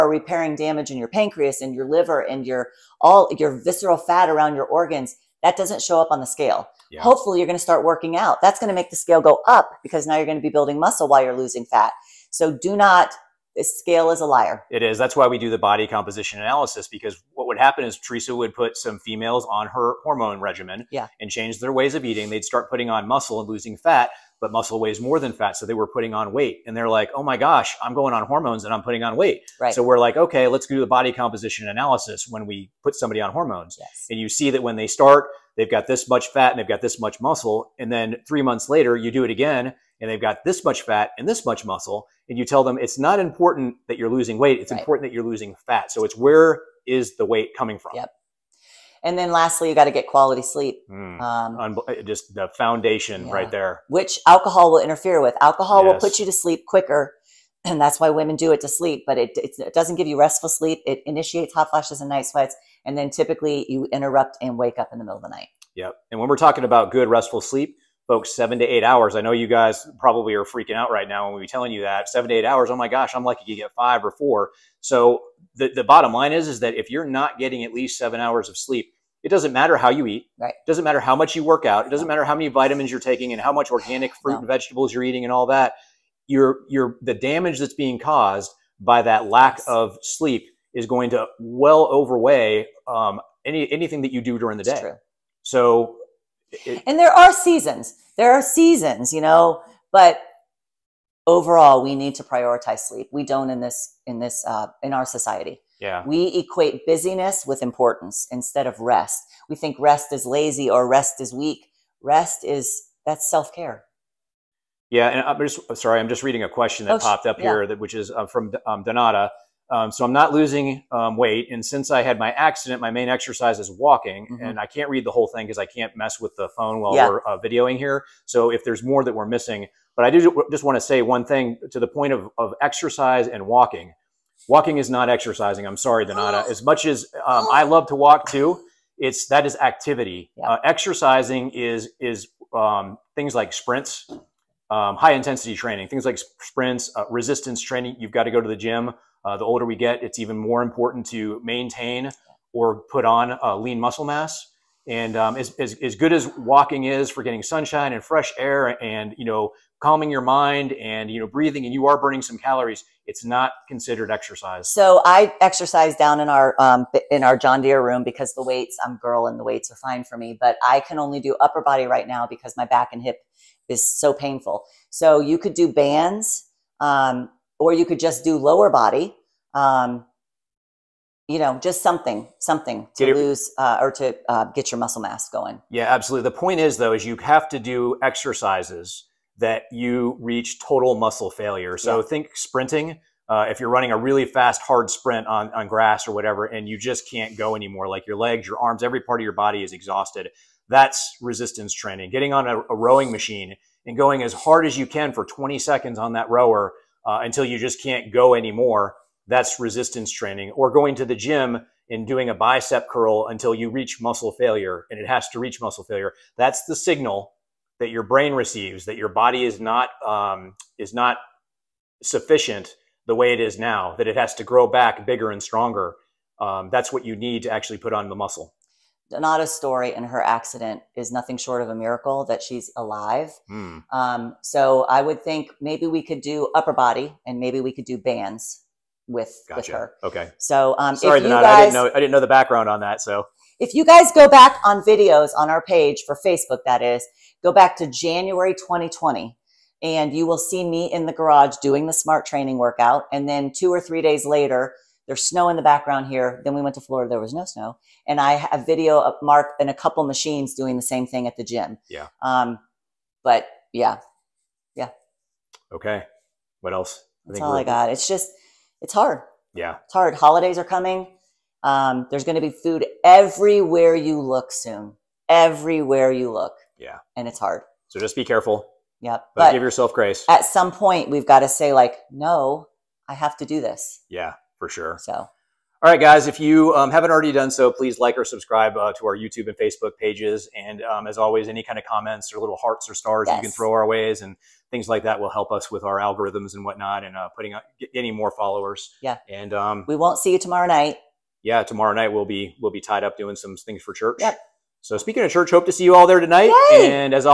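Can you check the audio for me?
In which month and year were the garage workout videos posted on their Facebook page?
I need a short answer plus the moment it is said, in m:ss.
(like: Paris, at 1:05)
January 2020, at 4:07.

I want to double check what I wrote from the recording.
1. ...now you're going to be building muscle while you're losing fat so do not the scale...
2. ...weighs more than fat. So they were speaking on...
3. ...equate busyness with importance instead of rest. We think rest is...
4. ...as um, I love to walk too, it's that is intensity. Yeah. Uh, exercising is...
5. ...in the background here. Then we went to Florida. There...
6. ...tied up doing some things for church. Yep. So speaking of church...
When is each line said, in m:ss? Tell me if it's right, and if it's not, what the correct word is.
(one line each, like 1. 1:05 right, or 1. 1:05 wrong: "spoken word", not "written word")
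1. 0:10 right
2. 0:24 wrong: "putting", not "speaking"
3. 1:46 right
4. 2:16 wrong: "activity", not "intensity"
5. 4:15 right
6. 5:02 right.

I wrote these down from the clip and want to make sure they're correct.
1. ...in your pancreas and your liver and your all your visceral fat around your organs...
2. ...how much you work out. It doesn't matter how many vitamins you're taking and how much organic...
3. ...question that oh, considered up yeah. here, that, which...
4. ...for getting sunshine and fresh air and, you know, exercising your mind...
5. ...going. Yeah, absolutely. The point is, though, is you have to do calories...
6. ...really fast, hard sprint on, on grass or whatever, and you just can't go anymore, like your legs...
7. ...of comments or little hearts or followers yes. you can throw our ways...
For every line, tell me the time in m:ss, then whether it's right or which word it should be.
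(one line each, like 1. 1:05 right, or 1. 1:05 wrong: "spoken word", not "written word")
1. 0:00 right
2. 1:21 right
3. 1:56 wrong: "popped", not "considered"
4. 2:37 wrong: "calming", not "exercising"
5. 3:05 wrong: "exercises", not "calories"
6. 3:13 right
7. 4:51 wrong: "stars", not "followers".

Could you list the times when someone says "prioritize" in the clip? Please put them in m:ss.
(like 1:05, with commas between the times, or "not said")
1:42.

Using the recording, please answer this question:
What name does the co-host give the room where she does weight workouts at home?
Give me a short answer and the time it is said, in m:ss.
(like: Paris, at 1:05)
John Deere room, at 2:47.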